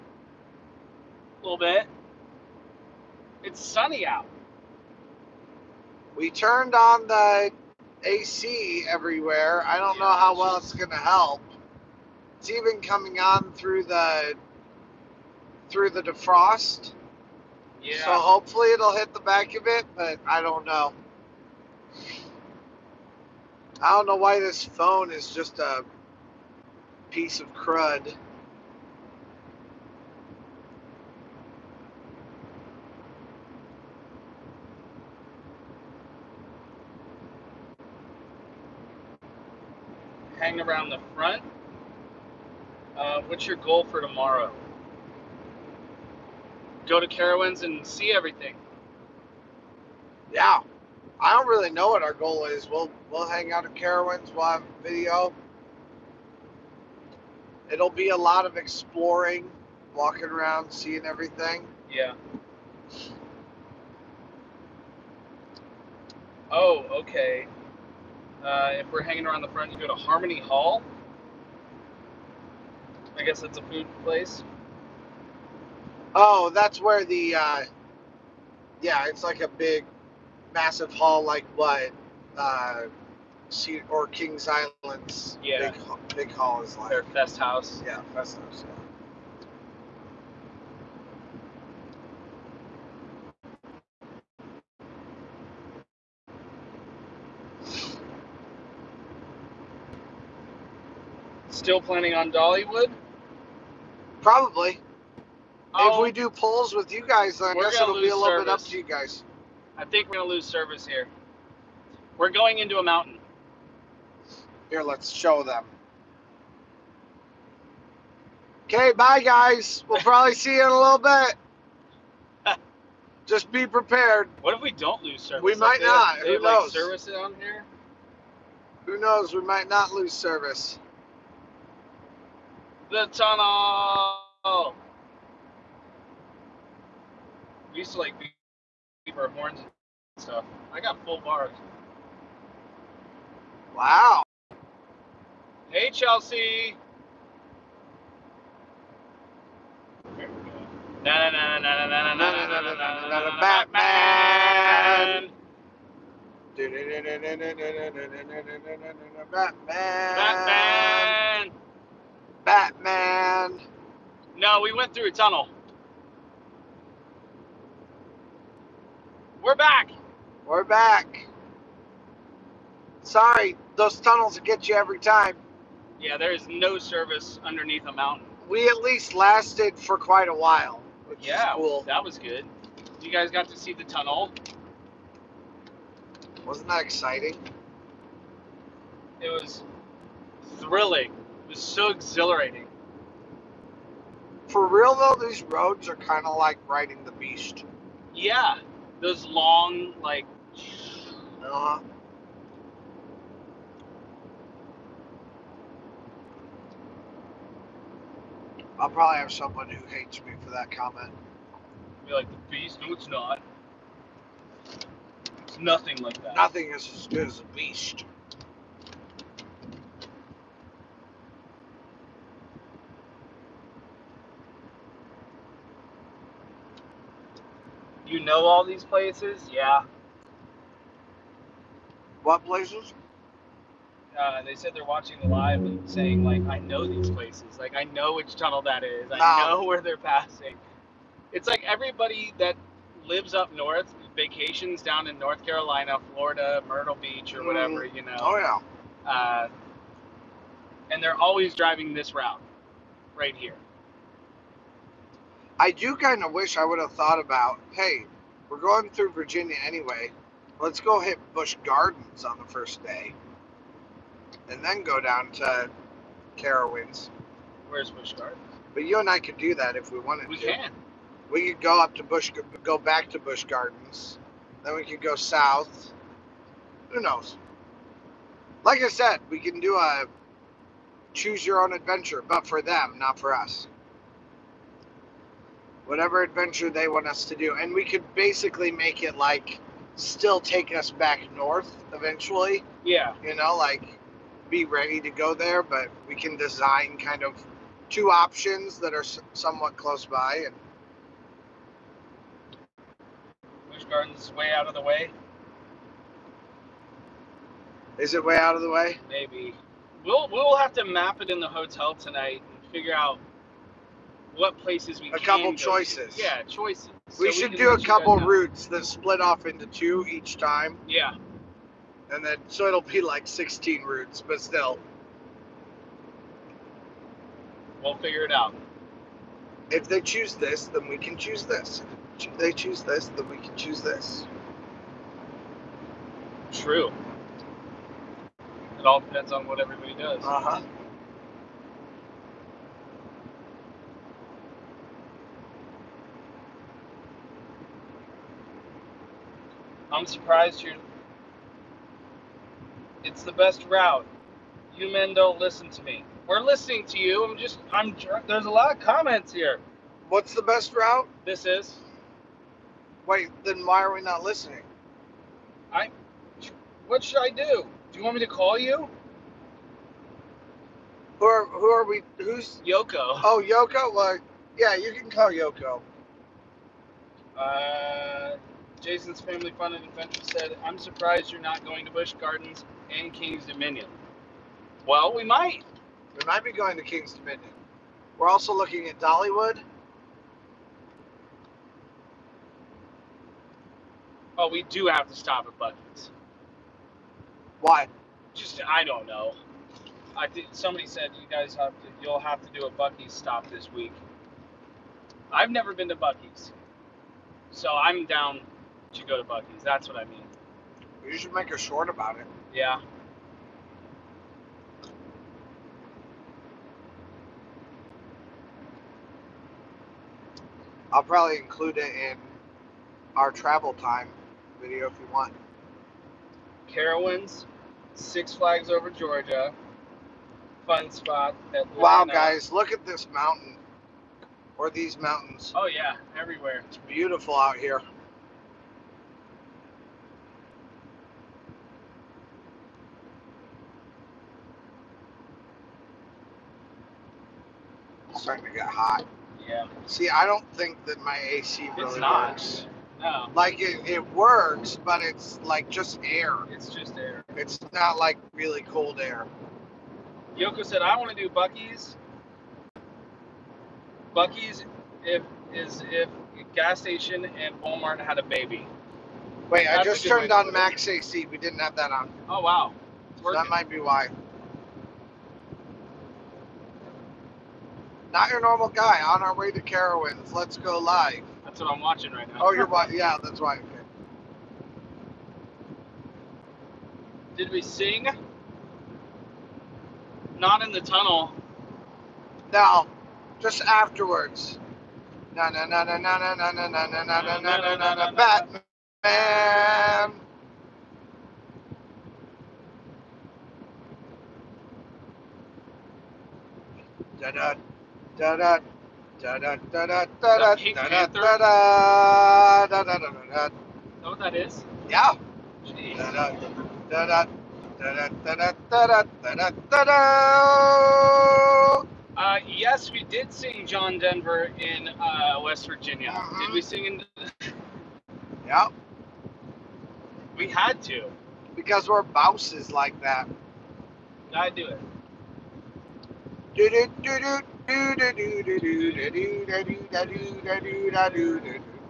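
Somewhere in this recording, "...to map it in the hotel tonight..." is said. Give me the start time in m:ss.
5:10.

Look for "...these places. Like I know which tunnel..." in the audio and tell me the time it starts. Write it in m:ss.
3:56.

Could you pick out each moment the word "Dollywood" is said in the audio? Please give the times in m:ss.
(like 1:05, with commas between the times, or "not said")
1:42, 6:28.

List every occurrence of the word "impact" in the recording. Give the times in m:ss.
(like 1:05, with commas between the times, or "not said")
not said.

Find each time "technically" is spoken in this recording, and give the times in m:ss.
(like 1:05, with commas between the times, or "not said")
not said.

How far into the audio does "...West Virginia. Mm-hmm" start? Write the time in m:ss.
8:45.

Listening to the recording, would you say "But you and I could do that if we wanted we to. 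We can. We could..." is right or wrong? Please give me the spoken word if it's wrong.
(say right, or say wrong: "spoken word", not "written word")
right.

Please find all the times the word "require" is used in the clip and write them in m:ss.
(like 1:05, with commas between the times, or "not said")
not said.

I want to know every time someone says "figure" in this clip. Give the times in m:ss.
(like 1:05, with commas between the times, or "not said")
5:12, 5:27.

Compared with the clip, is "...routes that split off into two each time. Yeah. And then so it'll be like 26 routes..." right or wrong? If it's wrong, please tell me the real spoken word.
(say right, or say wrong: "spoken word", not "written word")
wrong: "16", not "26".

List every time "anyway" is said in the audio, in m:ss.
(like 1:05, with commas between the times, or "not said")
4:19.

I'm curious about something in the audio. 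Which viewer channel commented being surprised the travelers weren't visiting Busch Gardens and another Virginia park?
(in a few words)
Jason's Family Fun and Adventure.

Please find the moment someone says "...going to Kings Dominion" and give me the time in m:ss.
6:26.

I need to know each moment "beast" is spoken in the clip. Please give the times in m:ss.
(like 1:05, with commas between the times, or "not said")
3:17, 3:32, 3:37.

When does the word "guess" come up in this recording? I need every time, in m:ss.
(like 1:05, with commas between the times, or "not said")
1:13, 1:47.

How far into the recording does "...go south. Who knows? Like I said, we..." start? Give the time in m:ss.
4:35.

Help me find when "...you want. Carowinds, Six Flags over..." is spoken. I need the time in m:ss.
7:04.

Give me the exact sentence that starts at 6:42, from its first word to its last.
You'll have to do a Buc-ee's stop this week.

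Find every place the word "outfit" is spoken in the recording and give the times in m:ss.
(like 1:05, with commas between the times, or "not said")
not said.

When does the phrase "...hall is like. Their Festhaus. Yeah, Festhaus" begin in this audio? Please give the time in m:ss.
1:26.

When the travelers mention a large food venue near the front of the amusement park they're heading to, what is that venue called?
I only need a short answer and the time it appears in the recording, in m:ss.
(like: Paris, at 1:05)
Harmony Hall, at 1:09.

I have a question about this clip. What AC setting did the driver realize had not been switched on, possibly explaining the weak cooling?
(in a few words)
Max AC.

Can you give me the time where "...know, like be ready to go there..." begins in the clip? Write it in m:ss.
4:53.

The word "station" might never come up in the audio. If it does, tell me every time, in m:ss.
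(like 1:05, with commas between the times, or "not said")
7:46.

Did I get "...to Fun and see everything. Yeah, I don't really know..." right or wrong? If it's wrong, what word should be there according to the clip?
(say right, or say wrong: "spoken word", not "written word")
wrong: "Carowinds", not "Fun".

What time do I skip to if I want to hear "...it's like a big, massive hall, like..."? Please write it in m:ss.
1:19.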